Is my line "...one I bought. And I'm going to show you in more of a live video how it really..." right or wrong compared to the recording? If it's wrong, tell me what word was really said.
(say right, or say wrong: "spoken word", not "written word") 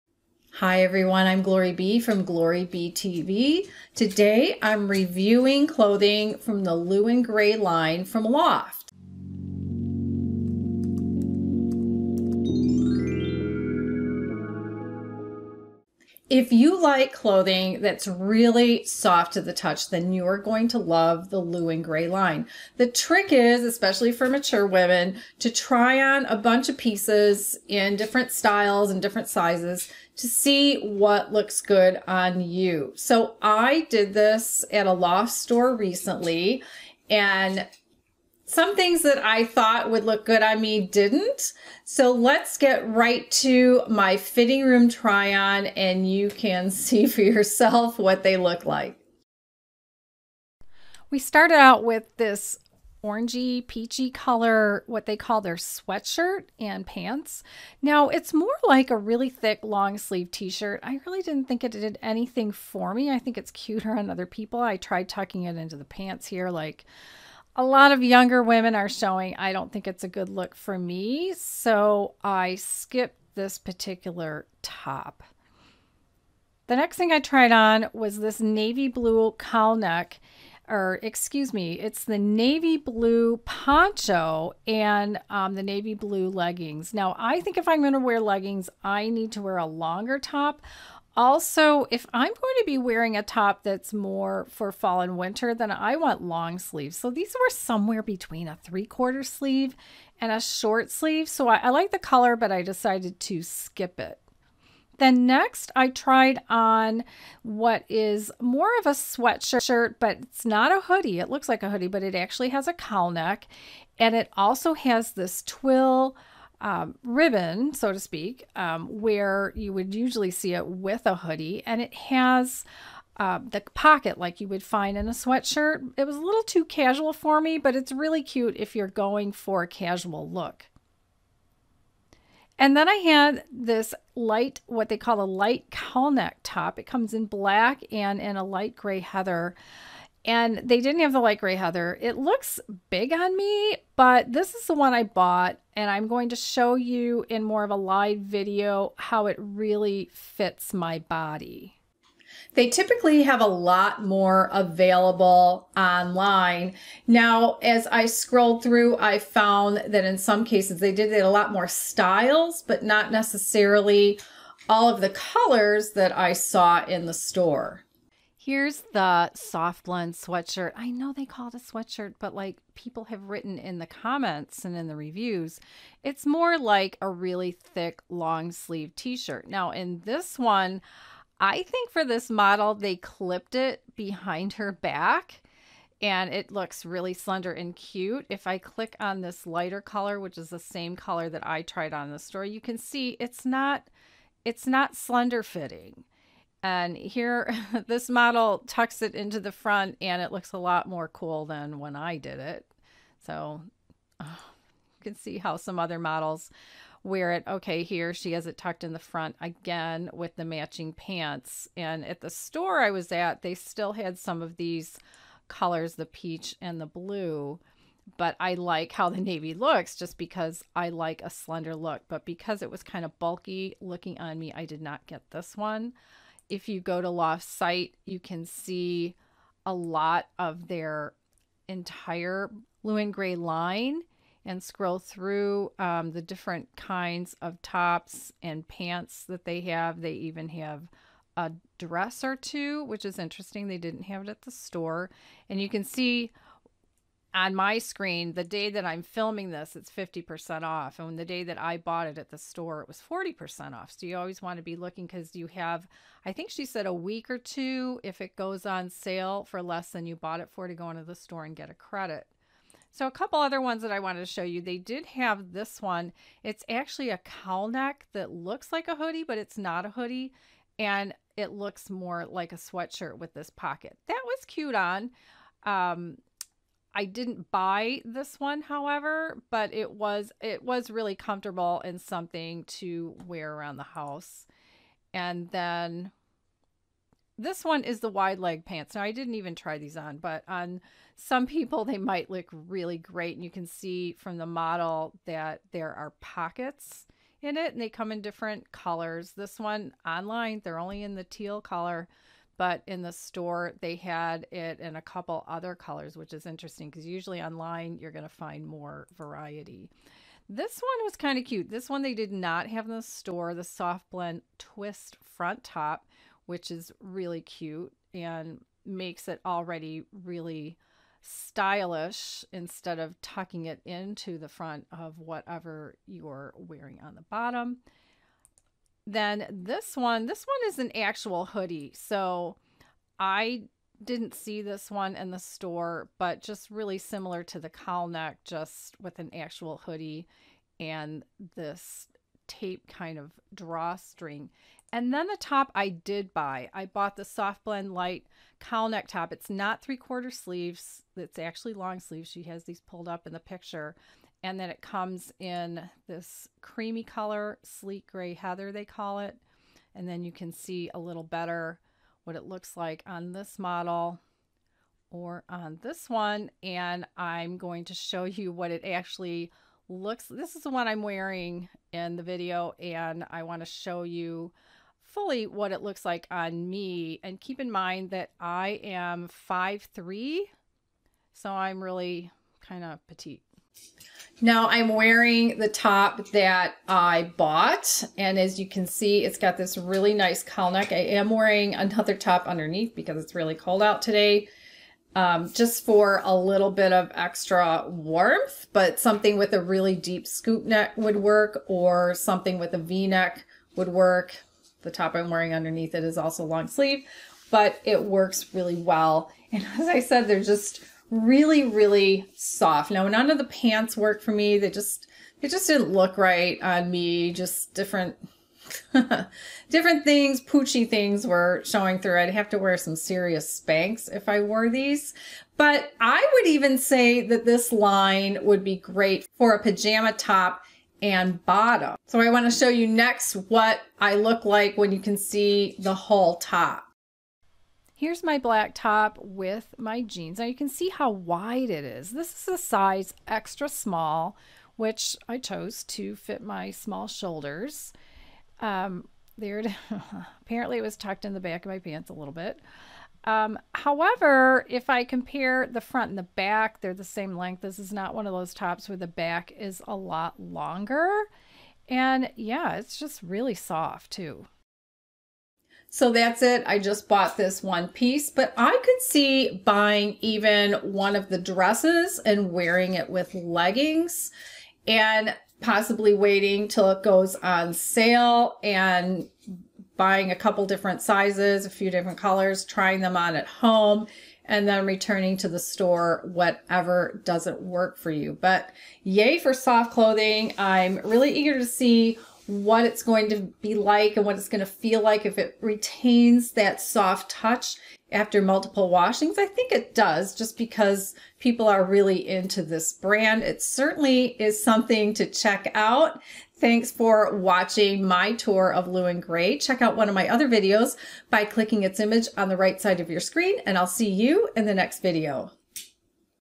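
right.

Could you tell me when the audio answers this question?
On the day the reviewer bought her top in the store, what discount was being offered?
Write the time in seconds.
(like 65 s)
253 s.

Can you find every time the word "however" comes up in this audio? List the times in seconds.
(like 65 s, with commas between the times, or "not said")
278 s, 453 s.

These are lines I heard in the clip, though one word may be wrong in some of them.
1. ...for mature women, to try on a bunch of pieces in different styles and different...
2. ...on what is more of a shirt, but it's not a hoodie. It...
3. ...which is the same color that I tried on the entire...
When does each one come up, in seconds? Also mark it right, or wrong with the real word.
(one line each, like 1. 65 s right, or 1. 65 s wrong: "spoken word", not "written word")
1. 24 s right
2. 106 s wrong: "sweatshirt", not "shirt"
3. 190 s wrong: "store", not "entire".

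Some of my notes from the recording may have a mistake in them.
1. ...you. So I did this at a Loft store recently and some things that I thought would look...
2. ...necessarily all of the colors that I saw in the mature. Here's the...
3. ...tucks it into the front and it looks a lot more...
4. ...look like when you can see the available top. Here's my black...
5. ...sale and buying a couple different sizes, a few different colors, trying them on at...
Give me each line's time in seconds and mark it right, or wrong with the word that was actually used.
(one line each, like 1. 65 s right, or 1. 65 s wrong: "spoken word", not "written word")
1. 32 s right
2. 163 s wrong: "store", not "mature"
3. 198 s right
4. 434 s wrong: "whole", not "available"
5. 477 s right.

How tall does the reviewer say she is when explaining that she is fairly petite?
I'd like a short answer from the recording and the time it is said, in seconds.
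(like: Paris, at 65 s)
5'3", at 379 s.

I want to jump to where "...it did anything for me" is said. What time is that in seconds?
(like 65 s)
61 s.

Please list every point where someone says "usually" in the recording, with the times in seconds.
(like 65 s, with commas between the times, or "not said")
119 s, 307 s.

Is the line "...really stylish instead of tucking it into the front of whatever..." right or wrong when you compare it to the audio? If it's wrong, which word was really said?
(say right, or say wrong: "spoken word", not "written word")
right.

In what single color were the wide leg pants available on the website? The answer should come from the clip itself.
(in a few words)
teal.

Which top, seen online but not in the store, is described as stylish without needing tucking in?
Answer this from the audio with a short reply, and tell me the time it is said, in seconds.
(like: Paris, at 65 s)
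soft blend twist front top, at 313 s.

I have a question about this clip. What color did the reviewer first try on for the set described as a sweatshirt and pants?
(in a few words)
orangey, peachy.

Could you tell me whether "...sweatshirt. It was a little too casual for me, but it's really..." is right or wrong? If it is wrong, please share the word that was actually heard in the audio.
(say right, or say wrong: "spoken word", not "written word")
right.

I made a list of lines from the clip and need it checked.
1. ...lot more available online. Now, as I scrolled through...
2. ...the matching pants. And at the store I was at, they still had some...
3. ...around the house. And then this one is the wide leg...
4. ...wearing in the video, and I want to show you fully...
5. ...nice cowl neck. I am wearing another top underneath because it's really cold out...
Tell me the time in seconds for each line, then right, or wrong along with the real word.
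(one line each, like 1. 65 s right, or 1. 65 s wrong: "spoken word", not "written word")
1. 153 s right
2. 210 s right
3. 283 s right
4. 371 s right
5. 390 s right.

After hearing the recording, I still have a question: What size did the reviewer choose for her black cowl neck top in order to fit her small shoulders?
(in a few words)
extra small.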